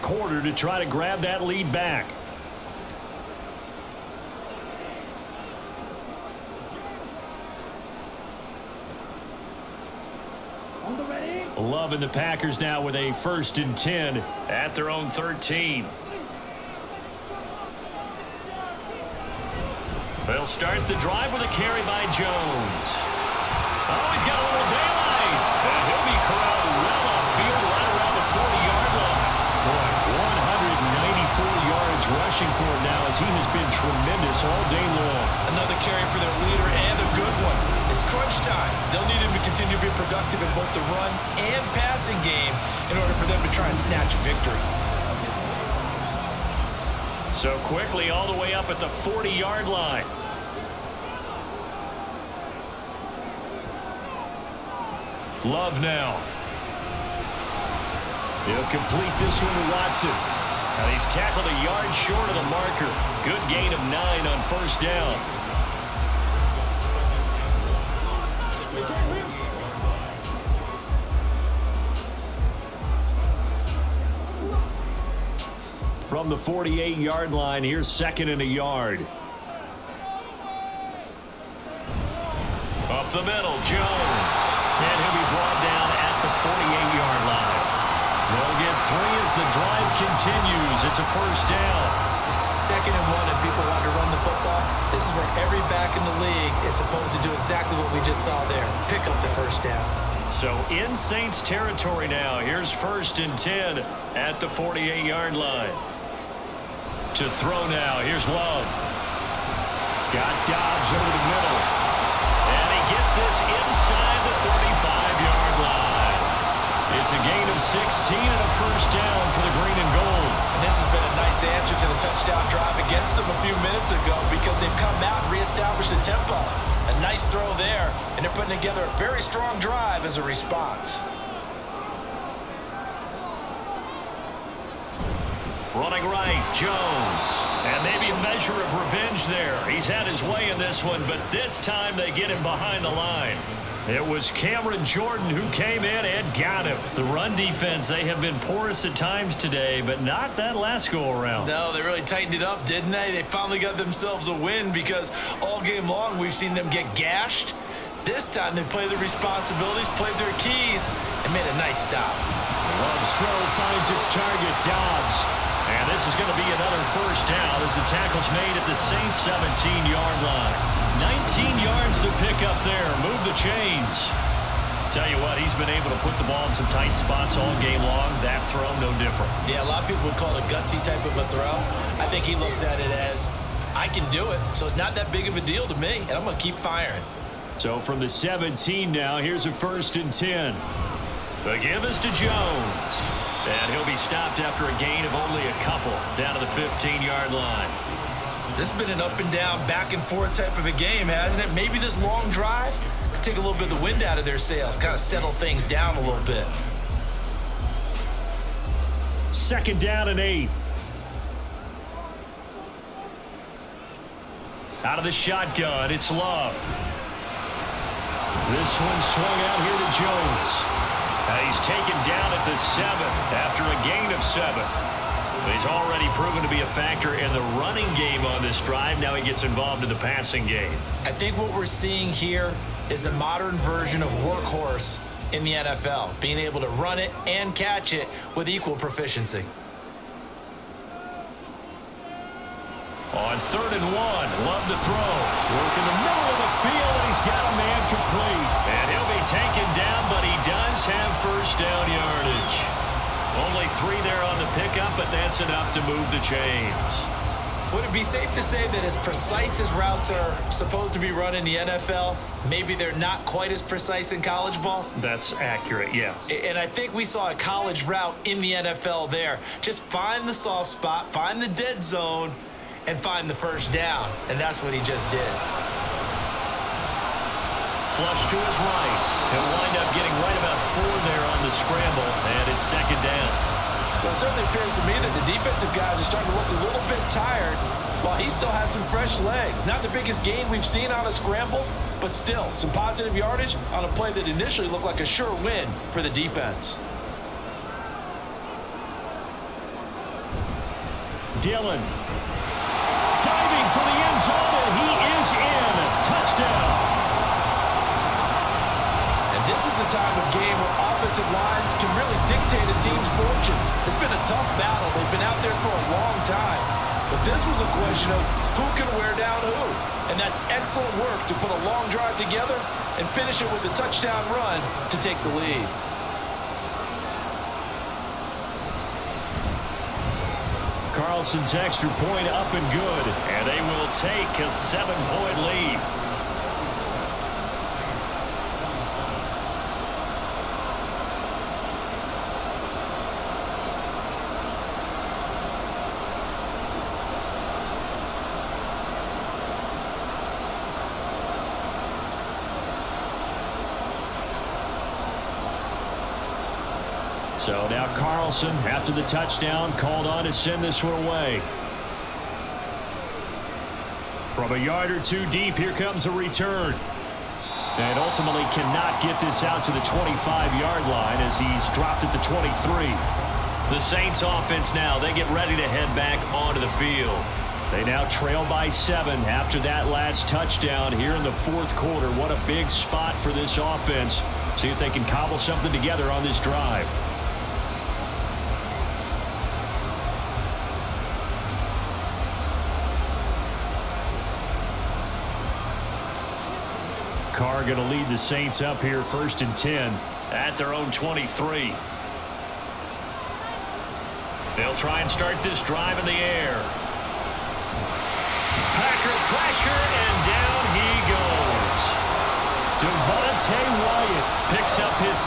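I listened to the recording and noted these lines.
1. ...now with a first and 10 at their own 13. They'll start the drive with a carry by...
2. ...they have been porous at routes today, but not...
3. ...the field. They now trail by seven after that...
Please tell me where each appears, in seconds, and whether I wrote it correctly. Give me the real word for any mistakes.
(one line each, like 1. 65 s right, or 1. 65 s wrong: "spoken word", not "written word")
1. 12 s right
2. 147 s wrong: "times", not "routes"
3. 376 s right.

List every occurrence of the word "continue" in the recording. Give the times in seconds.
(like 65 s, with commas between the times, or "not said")
39 s, 89 s.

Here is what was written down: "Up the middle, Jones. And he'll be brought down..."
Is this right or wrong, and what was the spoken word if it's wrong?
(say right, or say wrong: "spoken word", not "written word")
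right.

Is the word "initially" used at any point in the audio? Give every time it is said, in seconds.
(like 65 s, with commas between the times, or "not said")
294 s.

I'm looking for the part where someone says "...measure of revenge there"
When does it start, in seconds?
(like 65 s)
138 s.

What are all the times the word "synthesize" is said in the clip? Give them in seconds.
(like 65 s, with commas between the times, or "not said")
not said.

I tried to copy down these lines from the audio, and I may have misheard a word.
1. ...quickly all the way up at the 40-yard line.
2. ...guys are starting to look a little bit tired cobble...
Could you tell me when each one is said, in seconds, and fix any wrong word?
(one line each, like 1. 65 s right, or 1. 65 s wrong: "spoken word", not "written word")
1. 47 s right
2. 285 s wrong: "while", not "cobble".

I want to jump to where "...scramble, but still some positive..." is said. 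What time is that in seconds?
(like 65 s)
291 s.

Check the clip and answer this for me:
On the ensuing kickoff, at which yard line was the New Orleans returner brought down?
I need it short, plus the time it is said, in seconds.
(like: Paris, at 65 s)
23, at 372 s.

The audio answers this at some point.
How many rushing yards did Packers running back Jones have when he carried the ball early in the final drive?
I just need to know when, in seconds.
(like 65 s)
30 s.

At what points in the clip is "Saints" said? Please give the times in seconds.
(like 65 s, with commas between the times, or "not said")
100 s, 168 s, 373 s, 398 s.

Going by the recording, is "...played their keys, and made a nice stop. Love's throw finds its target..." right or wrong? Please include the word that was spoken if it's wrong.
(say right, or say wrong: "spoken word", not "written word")
right.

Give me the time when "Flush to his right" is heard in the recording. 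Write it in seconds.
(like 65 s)
277 s.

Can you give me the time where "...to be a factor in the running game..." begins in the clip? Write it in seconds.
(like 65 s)
226 s.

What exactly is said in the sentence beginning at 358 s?
Nelson, after the touchdown, called on to send this one away.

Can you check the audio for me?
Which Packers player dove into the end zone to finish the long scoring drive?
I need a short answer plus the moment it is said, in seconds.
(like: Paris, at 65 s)
Dillon, at 301 s.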